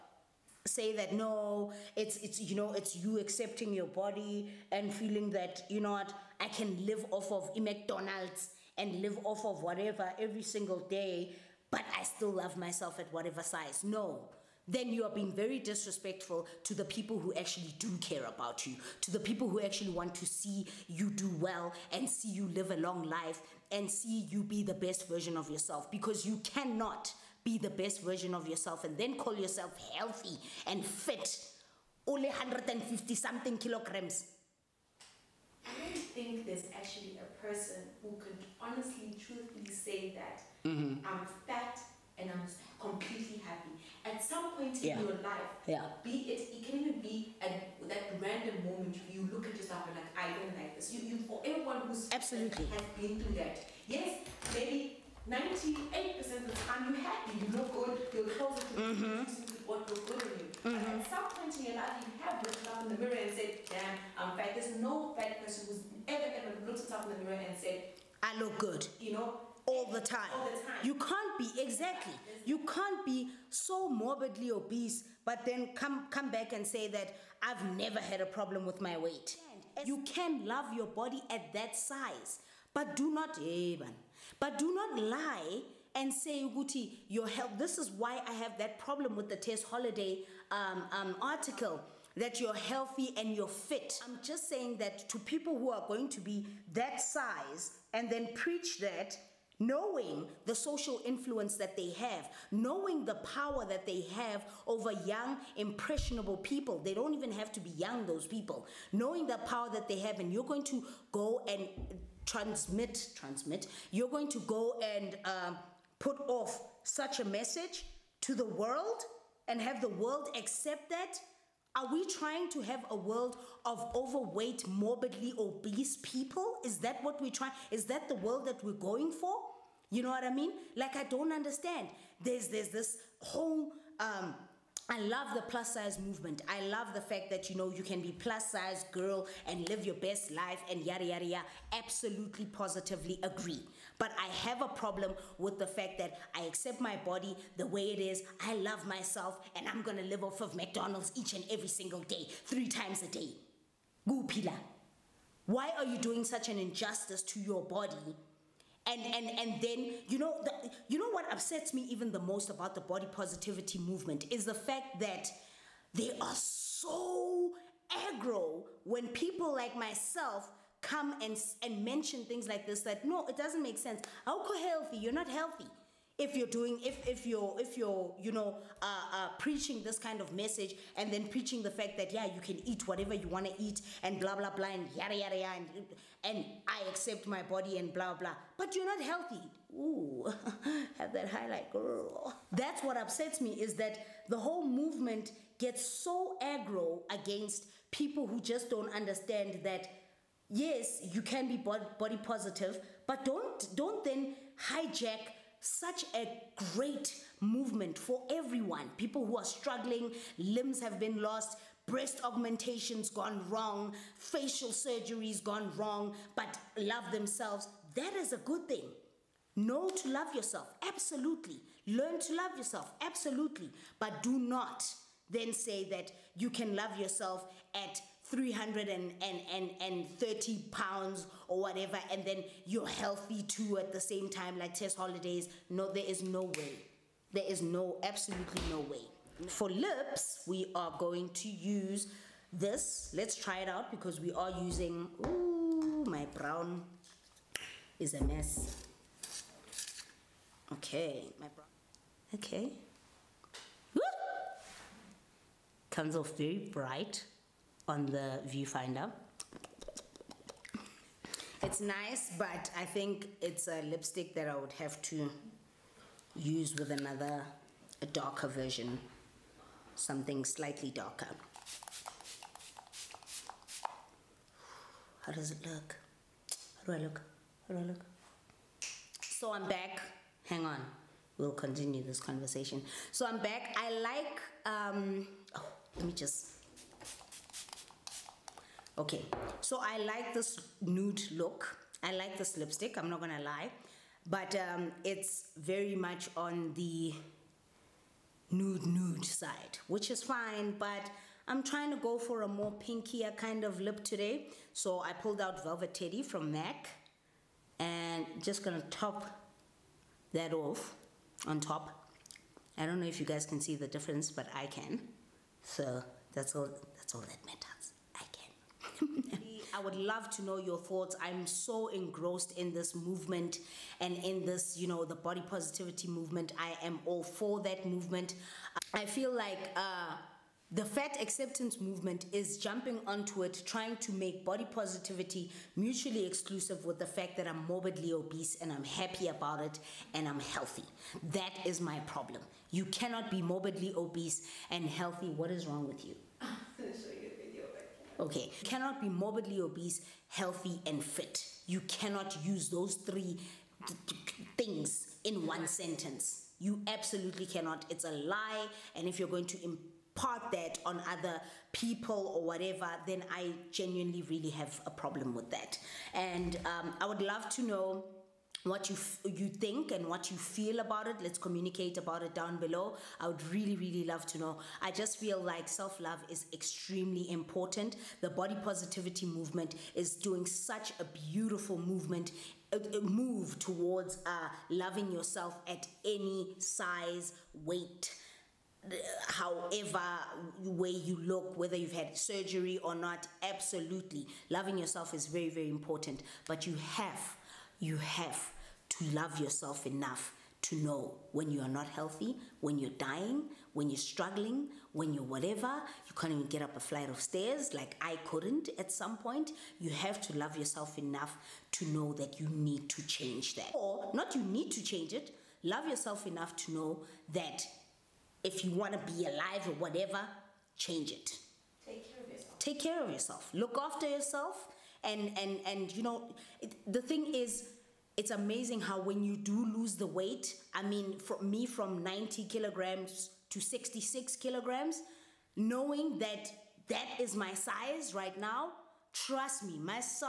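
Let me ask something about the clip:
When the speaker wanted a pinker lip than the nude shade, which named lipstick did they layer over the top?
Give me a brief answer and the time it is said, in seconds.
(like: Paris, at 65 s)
Velvet Teddy, at 305 s.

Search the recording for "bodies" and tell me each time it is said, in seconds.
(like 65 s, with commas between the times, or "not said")
not said.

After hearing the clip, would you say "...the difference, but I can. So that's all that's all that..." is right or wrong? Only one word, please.
right.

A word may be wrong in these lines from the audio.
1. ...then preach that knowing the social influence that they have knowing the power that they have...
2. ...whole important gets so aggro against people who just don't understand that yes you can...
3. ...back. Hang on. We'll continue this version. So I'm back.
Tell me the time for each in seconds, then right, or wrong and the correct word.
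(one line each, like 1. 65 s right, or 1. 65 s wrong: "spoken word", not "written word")
1. 98 s right
2. 194 s wrong: "movement", not "important"
3. 279 s wrong: "conversation", not "version".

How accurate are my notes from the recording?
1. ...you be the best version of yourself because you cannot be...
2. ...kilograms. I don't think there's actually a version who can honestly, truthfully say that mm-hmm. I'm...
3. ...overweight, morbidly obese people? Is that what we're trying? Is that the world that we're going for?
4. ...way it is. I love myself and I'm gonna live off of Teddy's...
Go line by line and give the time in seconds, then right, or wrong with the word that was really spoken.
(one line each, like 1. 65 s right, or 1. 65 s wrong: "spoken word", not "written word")
1. 24 s right
2. 33 s wrong: "person", not "version"
3. 123 s right
4. 147 s wrong: "McDonald", not "Teddy".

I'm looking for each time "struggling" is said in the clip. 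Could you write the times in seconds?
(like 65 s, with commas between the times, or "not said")
209 s, 403 s.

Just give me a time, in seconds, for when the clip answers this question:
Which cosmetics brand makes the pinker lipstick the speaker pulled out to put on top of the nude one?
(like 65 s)
306 s.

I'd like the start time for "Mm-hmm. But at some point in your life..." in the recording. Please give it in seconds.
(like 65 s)
60 s.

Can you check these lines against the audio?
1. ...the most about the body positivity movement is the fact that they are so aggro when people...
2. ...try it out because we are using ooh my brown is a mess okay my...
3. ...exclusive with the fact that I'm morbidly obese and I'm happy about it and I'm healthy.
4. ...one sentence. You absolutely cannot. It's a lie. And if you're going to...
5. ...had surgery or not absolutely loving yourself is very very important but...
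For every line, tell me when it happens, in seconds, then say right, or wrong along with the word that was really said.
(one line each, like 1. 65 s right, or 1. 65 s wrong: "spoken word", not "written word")
1. 162 s right
2. 243 s right
3. 336 s right
4. 355 s right
5. 391 s right.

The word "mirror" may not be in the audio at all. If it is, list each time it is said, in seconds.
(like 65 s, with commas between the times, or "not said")
62 s, 67 s.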